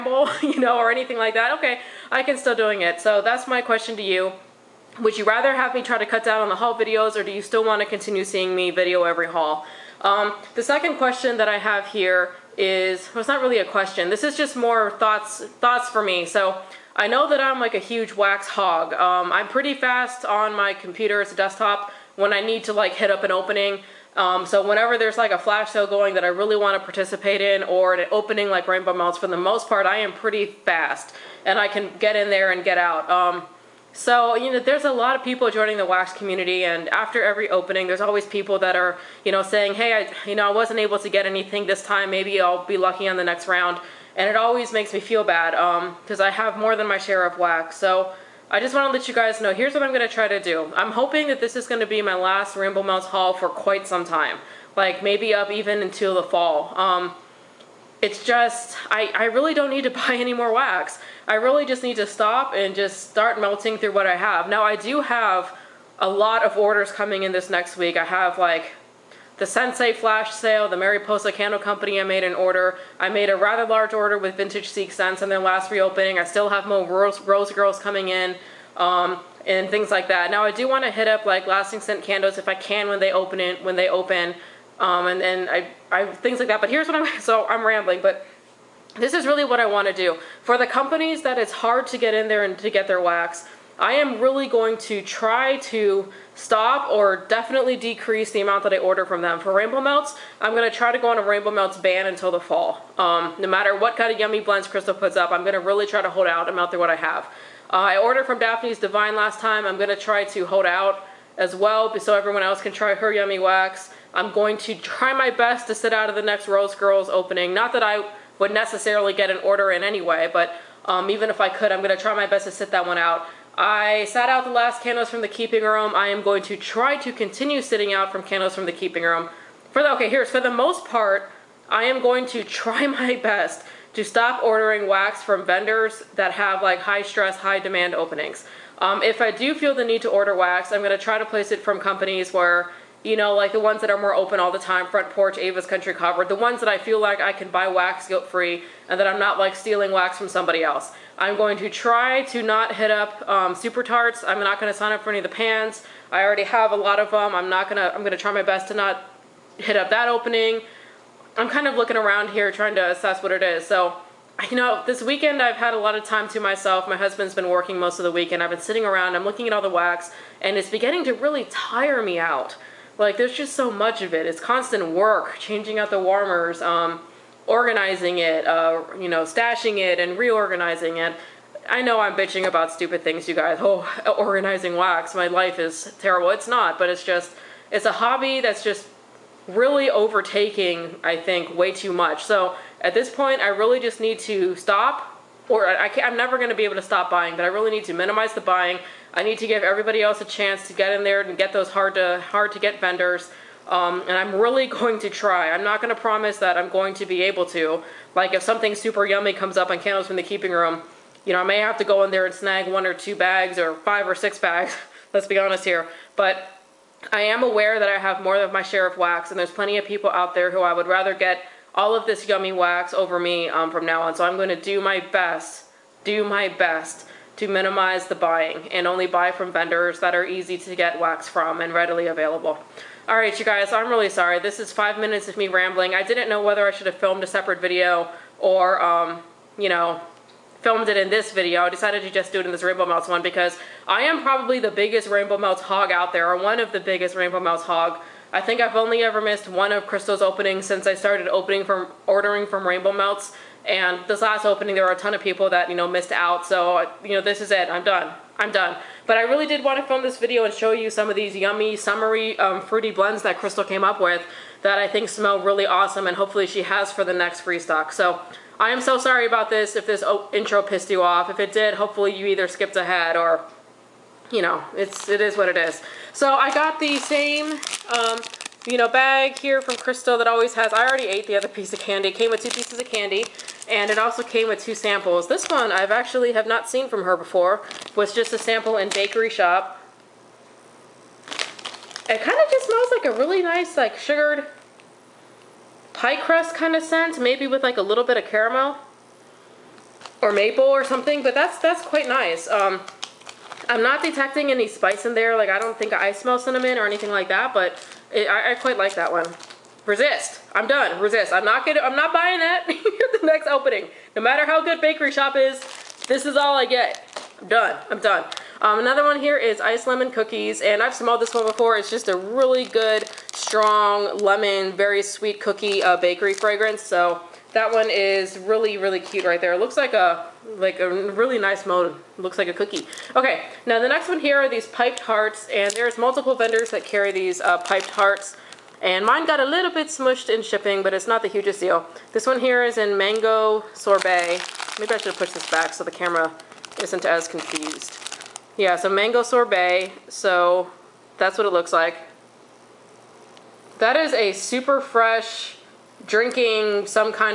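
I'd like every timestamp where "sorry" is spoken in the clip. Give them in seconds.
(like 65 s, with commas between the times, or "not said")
234 s, 268 s.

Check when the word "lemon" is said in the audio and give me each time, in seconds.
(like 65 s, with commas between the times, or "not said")
319 s, 324 s.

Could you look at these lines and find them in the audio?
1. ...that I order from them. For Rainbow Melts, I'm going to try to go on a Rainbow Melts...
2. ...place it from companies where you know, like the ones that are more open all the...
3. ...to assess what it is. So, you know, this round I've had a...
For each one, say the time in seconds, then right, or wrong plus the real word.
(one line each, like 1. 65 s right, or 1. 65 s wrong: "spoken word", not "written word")
1. 98 s right
2. 141 s right
3. 162 s wrong: "weekend", not "round".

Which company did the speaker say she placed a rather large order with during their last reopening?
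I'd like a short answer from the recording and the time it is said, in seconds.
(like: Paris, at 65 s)
Vintage Seek Sense, at 74 s.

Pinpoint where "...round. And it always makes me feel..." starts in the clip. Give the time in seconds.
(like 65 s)
43 s.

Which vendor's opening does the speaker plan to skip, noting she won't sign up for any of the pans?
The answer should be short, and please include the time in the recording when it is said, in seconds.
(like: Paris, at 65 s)
Super Tarts, at 153 s.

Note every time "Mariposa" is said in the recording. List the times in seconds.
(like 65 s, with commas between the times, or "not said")
70 s.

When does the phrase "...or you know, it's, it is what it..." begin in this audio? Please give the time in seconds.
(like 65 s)
273 s.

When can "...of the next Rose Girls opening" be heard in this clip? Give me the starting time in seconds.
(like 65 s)
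116 s.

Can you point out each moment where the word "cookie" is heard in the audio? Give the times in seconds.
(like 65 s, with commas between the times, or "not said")
320 s, 325 s, 332 s.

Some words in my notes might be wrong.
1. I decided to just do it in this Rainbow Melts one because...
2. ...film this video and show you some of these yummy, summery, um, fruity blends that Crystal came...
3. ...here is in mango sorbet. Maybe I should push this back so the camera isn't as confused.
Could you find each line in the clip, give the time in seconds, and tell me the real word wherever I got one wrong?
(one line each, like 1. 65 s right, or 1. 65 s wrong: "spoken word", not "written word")
1. 241 s right
2. 259 s right
3. 342 s right.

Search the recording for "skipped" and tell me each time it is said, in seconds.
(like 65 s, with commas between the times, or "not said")
272 s.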